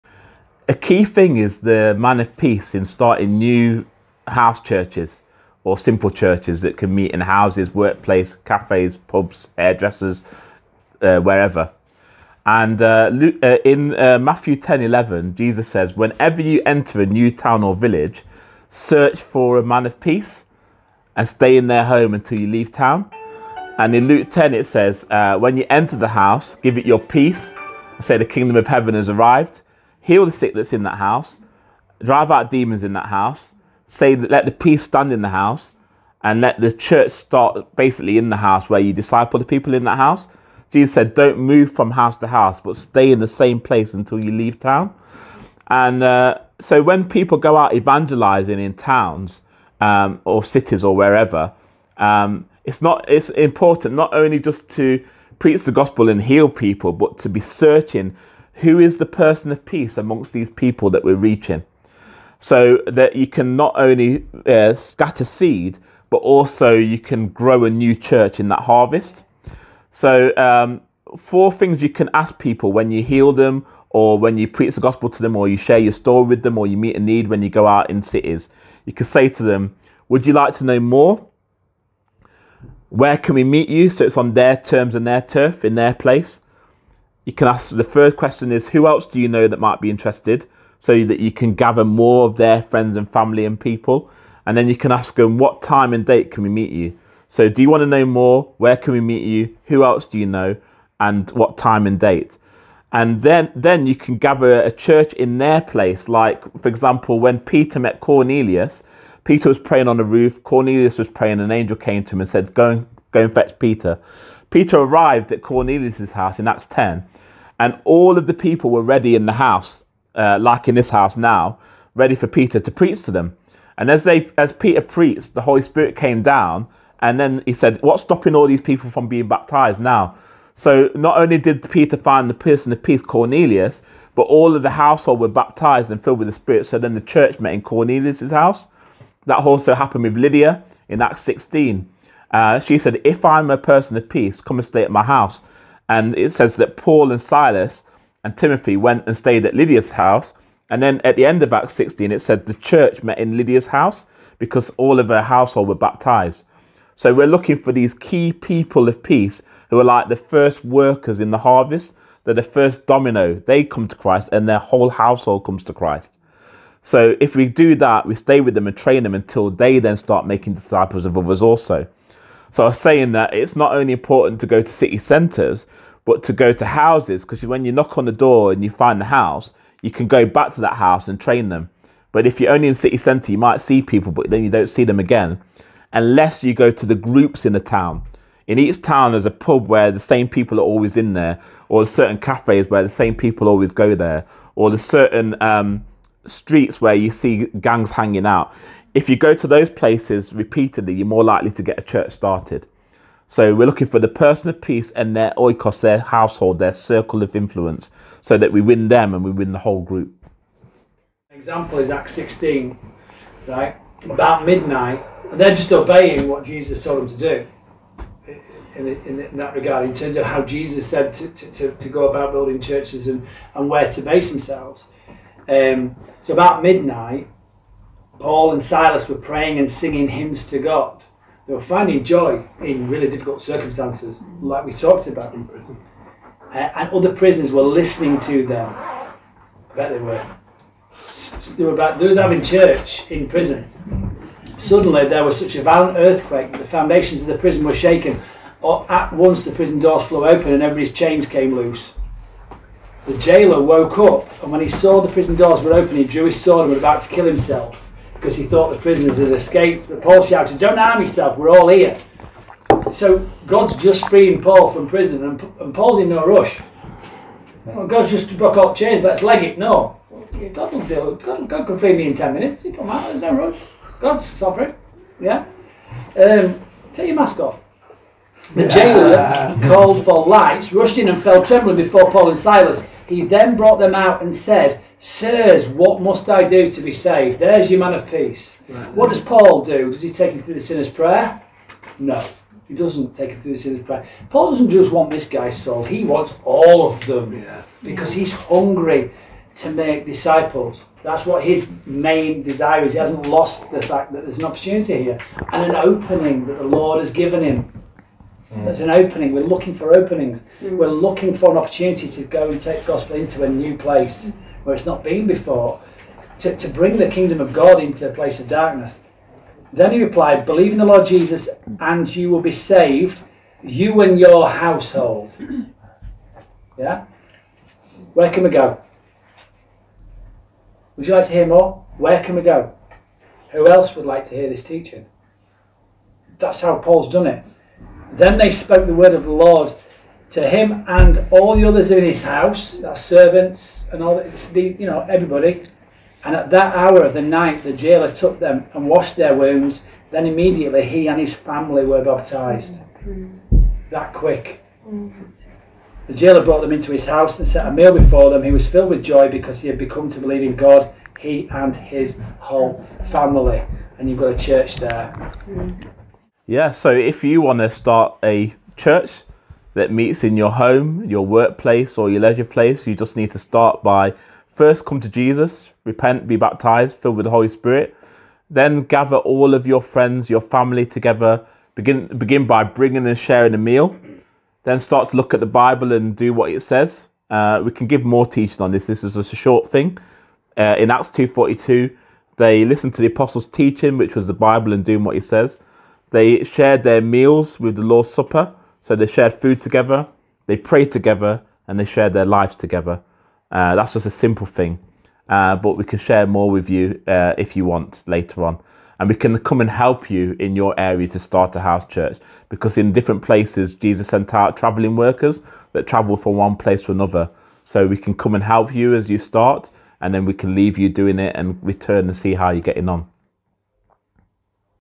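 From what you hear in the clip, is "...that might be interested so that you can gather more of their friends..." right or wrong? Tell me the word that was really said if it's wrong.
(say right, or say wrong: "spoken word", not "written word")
right.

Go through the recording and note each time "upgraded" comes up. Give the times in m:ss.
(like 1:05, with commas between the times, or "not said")
not said.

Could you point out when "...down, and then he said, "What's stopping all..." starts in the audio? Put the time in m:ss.
2:06.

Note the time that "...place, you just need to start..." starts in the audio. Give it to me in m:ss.
6:12.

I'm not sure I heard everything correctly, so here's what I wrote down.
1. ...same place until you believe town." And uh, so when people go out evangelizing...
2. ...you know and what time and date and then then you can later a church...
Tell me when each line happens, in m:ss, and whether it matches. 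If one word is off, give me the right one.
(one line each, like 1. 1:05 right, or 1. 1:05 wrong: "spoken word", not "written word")
1. 0:43 wrong: "leave", not "believe"
2. 1:40 wrong: "gather", not "later".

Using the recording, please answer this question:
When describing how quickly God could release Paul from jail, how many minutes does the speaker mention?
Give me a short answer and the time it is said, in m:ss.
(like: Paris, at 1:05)
10 minutes, at 4:32.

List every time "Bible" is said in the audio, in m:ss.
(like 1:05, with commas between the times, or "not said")
6:25, 6:34.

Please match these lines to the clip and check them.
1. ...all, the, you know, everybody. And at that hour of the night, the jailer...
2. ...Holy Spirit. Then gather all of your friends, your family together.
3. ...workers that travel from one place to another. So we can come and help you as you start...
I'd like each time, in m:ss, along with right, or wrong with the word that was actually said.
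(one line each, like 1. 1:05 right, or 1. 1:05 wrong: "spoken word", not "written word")
1. 5:44 right
2. 6:17 right
3. 6:54 right.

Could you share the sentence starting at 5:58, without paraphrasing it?
He was filled with joy because he had become to believe in God, he and his whole family.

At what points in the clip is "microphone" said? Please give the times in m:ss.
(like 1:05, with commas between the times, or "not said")
not said.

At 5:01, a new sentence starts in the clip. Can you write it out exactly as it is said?
That's what his main desire is.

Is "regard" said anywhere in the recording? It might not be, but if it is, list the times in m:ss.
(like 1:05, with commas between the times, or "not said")
3:39.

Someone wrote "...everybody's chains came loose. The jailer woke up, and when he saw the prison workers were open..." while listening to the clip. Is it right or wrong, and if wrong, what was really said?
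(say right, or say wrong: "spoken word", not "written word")
wrong: "doors", not "workers".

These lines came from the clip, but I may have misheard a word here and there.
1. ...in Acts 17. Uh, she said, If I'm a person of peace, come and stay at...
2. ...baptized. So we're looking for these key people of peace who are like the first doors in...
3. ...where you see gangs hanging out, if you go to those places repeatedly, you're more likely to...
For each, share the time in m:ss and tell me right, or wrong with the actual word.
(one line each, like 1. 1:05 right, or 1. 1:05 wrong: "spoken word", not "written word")
1. 2:20 wrong: "16", not "17"
2. 2:35 wrong: "workers", not "doors"
3. 3:16 right.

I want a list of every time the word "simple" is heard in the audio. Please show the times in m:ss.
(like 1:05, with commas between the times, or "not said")
0:05, 6:44.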